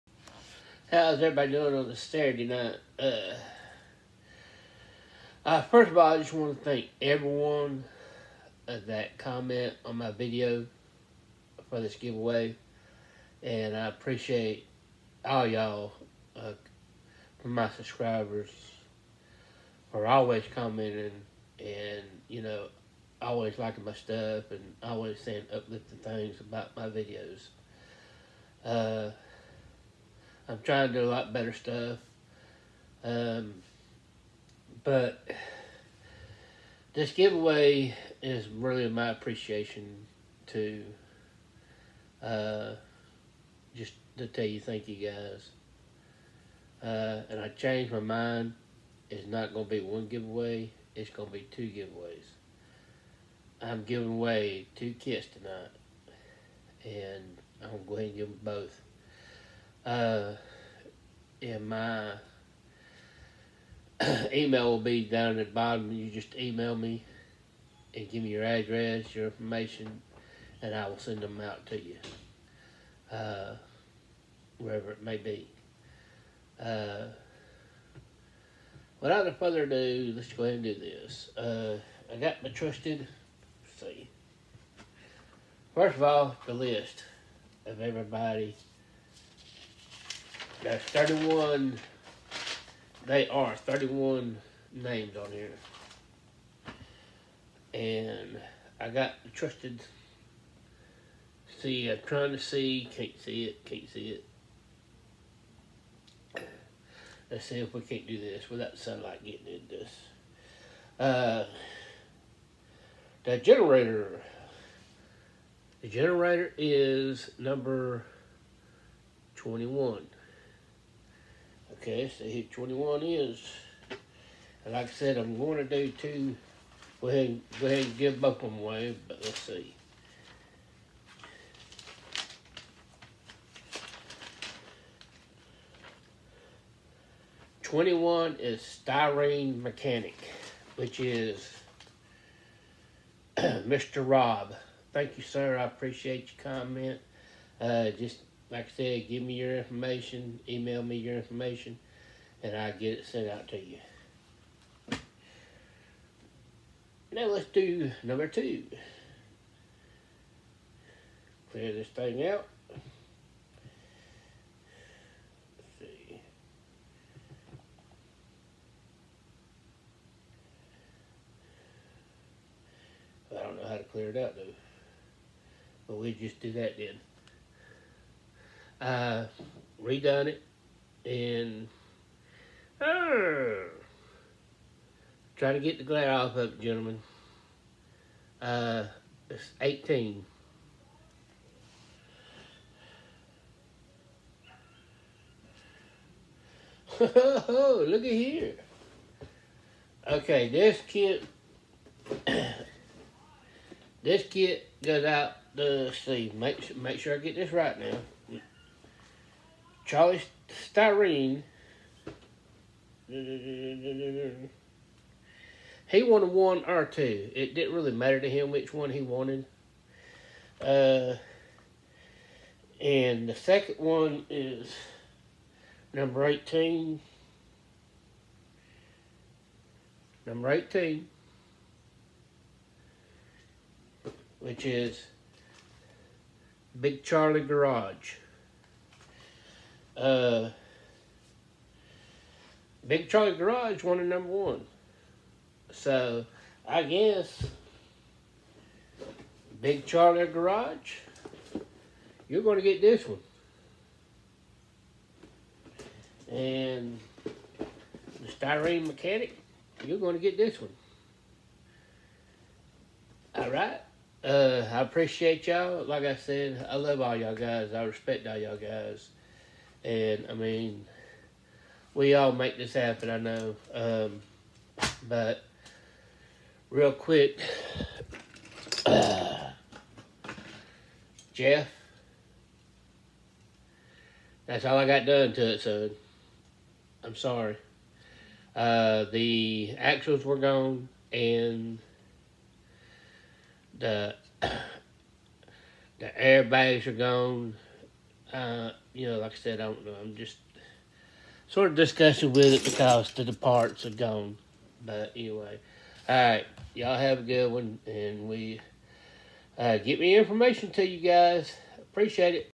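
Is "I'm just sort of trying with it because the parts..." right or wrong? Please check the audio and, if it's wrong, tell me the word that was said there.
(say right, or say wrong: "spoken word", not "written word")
wrong: "discussing", not "trying".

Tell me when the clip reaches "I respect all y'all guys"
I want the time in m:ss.
4:27.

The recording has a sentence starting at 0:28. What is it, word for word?
Uh, I've tried to do a lot better stuff.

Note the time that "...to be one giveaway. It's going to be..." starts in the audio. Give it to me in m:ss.
0:49.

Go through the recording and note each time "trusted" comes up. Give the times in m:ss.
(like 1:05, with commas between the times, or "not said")
1:22, 1:39.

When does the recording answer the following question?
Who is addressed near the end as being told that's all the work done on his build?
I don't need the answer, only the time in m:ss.
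4:41.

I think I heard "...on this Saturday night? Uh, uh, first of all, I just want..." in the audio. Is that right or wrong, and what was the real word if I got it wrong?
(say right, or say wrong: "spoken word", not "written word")
right.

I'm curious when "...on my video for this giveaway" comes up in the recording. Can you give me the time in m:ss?
0:09.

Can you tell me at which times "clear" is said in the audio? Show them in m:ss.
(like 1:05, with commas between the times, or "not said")
2:41, 2:53.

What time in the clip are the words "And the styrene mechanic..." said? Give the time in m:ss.
4:16.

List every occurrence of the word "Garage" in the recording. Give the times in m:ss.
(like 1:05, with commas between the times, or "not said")
3:57, 4:03, 4:10.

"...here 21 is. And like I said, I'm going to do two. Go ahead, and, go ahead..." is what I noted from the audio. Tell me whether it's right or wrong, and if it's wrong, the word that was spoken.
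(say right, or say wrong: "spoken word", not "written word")
right.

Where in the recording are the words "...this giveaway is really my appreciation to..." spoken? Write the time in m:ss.
0:36.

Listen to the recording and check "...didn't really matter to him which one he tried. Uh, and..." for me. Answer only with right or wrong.
wrong.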